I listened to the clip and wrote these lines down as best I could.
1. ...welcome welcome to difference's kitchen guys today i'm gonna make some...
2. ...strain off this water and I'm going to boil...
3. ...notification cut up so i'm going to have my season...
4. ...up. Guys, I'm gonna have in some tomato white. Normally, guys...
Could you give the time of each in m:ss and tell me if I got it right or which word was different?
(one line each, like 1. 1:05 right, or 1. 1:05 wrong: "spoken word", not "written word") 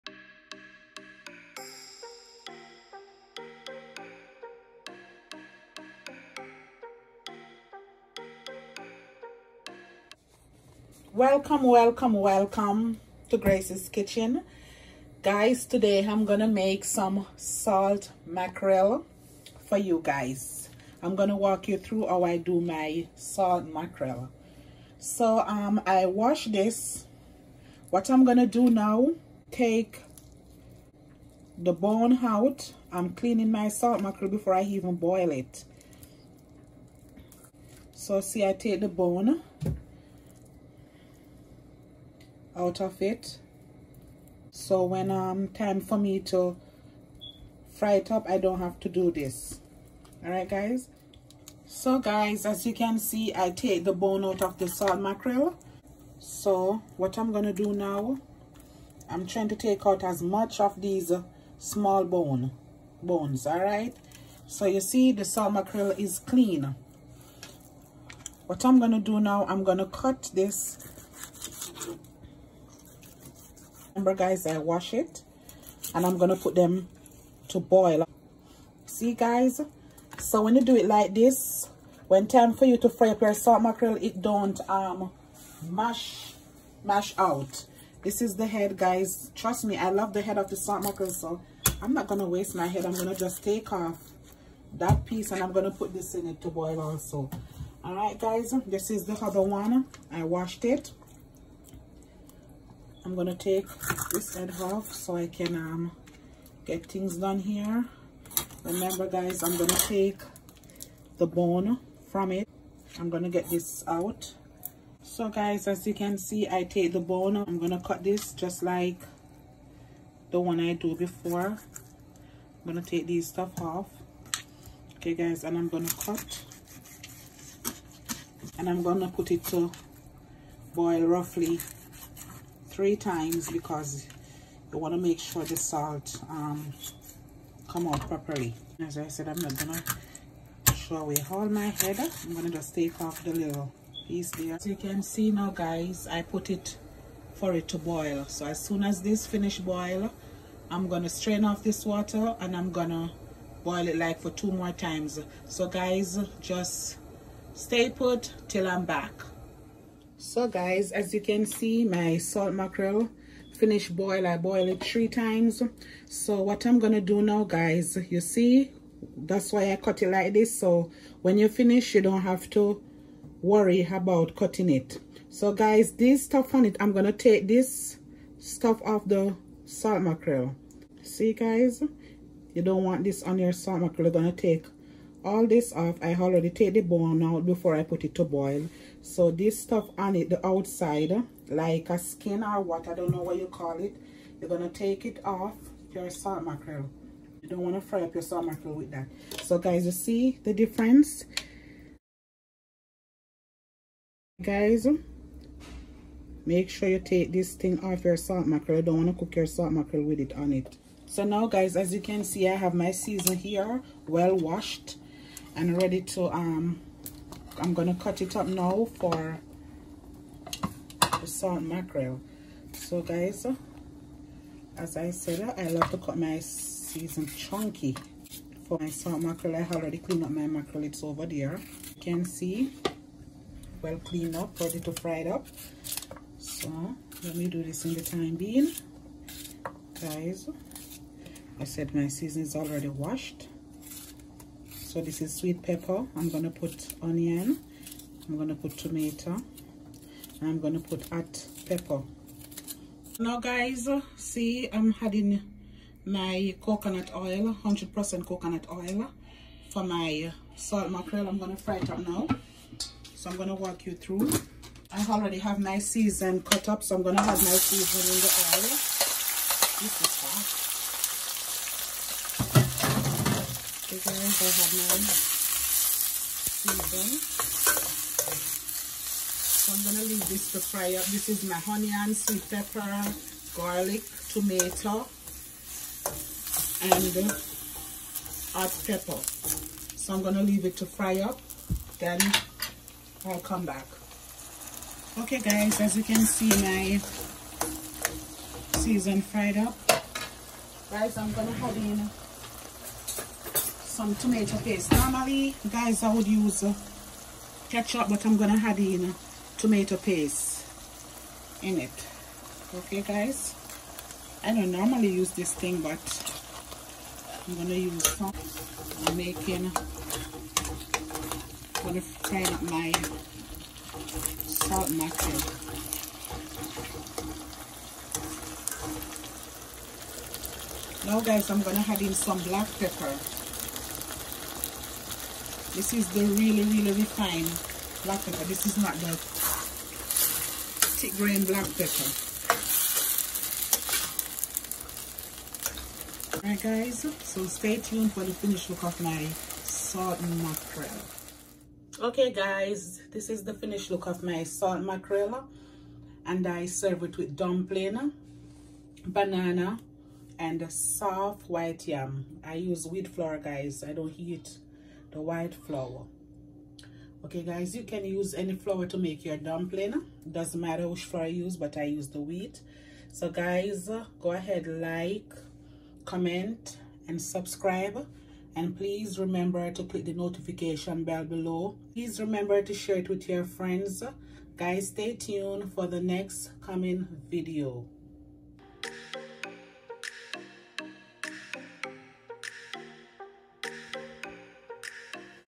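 1. 0:11 wrong: "grace", not "difference"
2. 2:31 right
3. 4:25 wrong: "season", not "notification"
4. 4:59 wrong: "paste", not "white".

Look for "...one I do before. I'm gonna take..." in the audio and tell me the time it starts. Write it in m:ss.
2:00.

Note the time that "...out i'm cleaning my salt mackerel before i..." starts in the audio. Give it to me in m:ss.
0:32.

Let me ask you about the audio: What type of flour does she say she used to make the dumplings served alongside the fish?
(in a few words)
Wheat flour.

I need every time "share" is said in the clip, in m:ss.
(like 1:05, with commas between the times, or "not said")
6:22.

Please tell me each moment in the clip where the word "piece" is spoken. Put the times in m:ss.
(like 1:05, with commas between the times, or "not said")
1:35, 2:24.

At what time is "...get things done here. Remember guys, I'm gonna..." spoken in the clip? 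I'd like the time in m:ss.
1:46.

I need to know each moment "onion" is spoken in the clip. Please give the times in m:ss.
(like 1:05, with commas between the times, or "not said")
4:07, 4:41.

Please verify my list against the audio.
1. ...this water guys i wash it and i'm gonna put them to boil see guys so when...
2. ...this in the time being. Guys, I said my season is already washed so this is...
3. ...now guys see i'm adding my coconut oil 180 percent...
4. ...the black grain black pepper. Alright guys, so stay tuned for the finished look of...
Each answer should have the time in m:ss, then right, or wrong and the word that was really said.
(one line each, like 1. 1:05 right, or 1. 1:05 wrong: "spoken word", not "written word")
1. 1:10 wrong: "remember", not "water"
2. 3:57 right
3. 4:13 wrong: "100", not "180"
4. 5:38 wrong: "thick", not "black".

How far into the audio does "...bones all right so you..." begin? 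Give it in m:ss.
1:03.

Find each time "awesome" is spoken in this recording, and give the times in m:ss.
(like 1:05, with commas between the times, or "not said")
not said.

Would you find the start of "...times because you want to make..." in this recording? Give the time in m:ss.
2:12.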